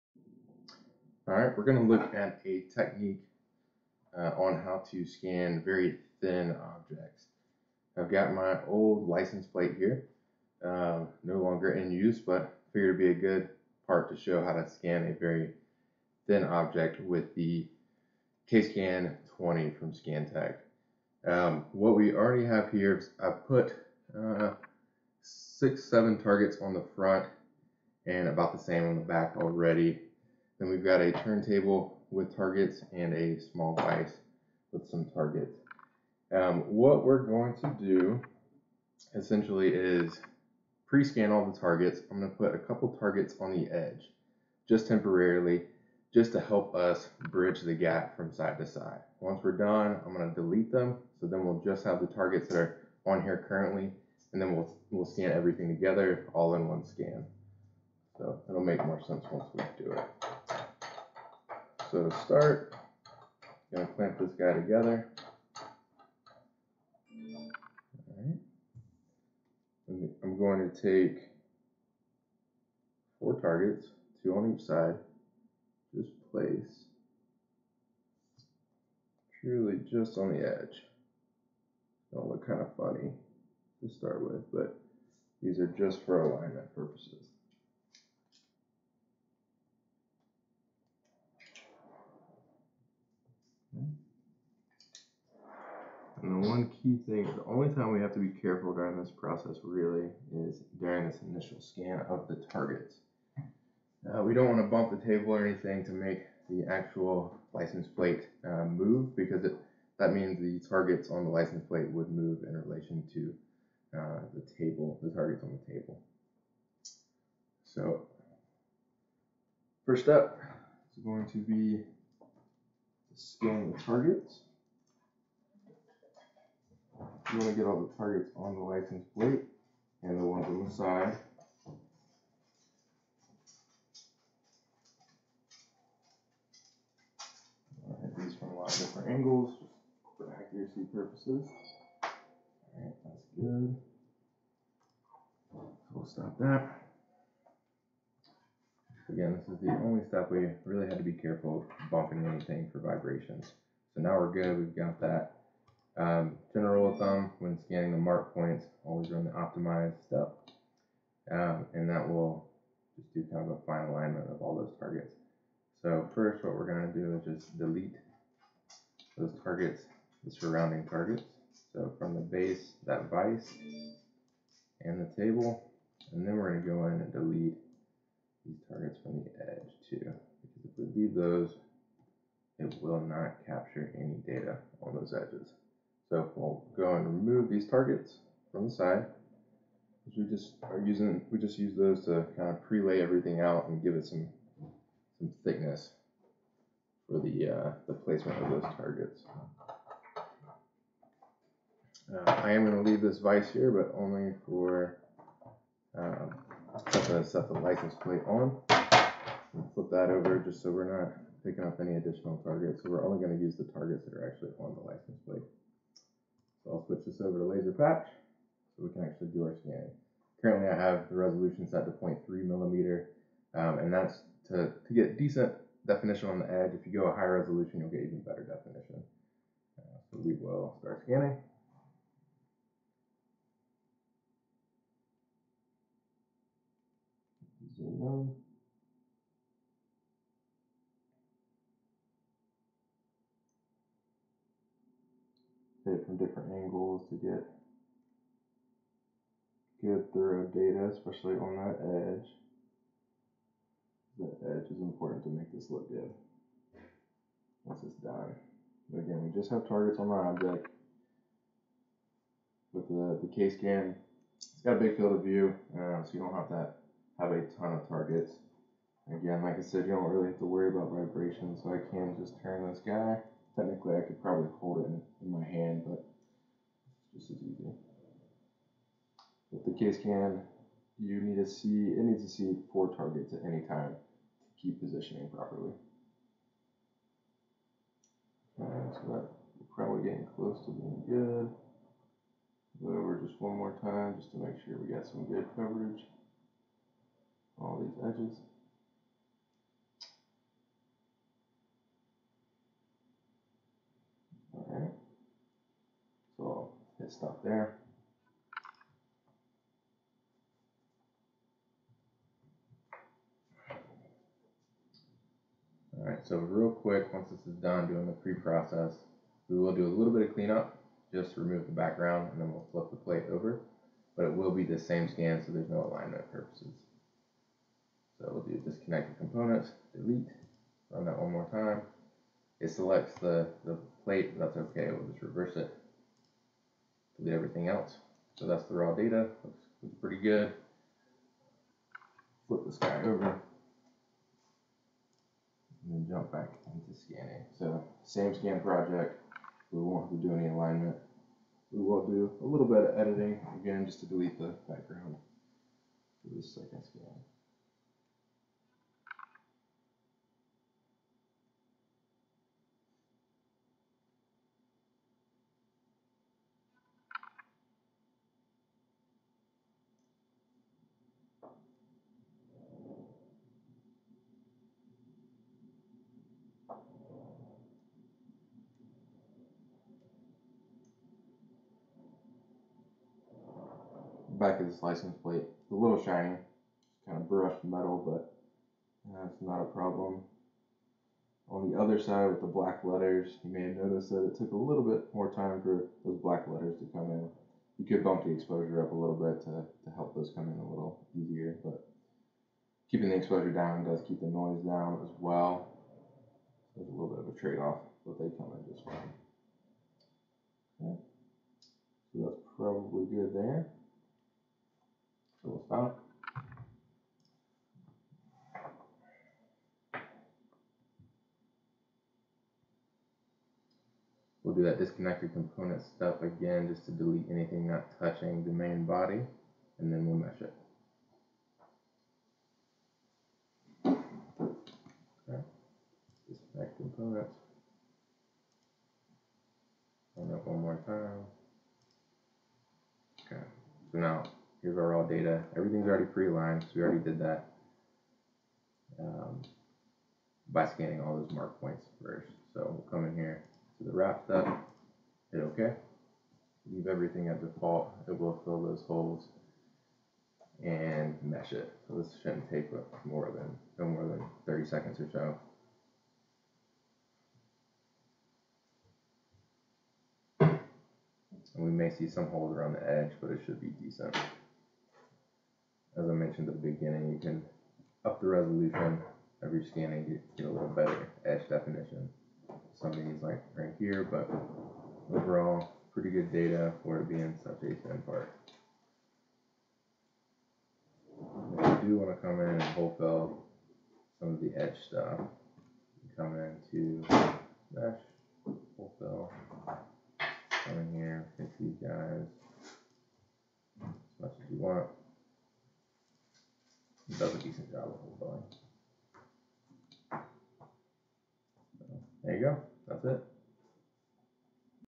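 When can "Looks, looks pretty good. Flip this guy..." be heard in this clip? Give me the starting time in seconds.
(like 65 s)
339 s.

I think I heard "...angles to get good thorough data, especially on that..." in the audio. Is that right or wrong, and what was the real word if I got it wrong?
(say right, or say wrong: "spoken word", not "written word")
right.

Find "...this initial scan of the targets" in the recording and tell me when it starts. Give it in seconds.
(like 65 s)
101 s.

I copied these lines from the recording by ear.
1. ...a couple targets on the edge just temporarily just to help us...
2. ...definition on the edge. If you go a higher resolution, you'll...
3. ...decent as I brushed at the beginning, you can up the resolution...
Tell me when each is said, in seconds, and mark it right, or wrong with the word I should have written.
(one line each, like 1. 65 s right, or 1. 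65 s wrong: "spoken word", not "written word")
1. 42 s right
2. 225 s right
3. 473 s wrong: "mentioned", not "brushed".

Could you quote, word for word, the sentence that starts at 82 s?
Don't look kind of funny to start with, but these are just for alignment purposes.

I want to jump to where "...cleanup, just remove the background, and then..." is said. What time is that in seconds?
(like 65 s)
320 s.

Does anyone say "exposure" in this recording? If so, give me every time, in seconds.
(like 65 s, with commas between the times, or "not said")
398 s, 403 s.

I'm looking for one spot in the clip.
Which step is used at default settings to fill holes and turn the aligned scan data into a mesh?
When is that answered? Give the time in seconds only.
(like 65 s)
453 s.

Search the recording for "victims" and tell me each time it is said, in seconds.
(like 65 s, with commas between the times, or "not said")
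not said.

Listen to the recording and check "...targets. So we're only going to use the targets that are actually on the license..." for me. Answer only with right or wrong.
right.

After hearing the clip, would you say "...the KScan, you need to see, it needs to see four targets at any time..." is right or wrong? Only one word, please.
right.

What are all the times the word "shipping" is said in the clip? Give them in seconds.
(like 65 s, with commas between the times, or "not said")
not said.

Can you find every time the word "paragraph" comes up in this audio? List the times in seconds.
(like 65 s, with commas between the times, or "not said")
not said.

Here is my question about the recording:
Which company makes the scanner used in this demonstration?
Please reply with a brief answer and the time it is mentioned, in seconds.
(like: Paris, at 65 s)
Scantech, at 19 s.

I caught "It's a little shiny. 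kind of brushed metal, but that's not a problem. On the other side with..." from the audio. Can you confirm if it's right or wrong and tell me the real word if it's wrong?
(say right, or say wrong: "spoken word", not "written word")
right.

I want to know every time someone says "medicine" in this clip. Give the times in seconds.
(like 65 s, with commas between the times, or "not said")
not said.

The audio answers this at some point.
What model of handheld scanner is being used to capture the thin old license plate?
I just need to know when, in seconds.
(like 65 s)
18 s.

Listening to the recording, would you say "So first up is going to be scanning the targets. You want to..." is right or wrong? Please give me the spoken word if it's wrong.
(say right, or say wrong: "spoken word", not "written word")
right.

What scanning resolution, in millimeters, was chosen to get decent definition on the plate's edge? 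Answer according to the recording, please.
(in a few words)
0.3 mm.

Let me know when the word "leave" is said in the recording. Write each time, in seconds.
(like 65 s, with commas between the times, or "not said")
181 s, 202 s, 456 s.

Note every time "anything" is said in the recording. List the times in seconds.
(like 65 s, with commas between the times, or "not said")
105 s, 152 s, 427 s.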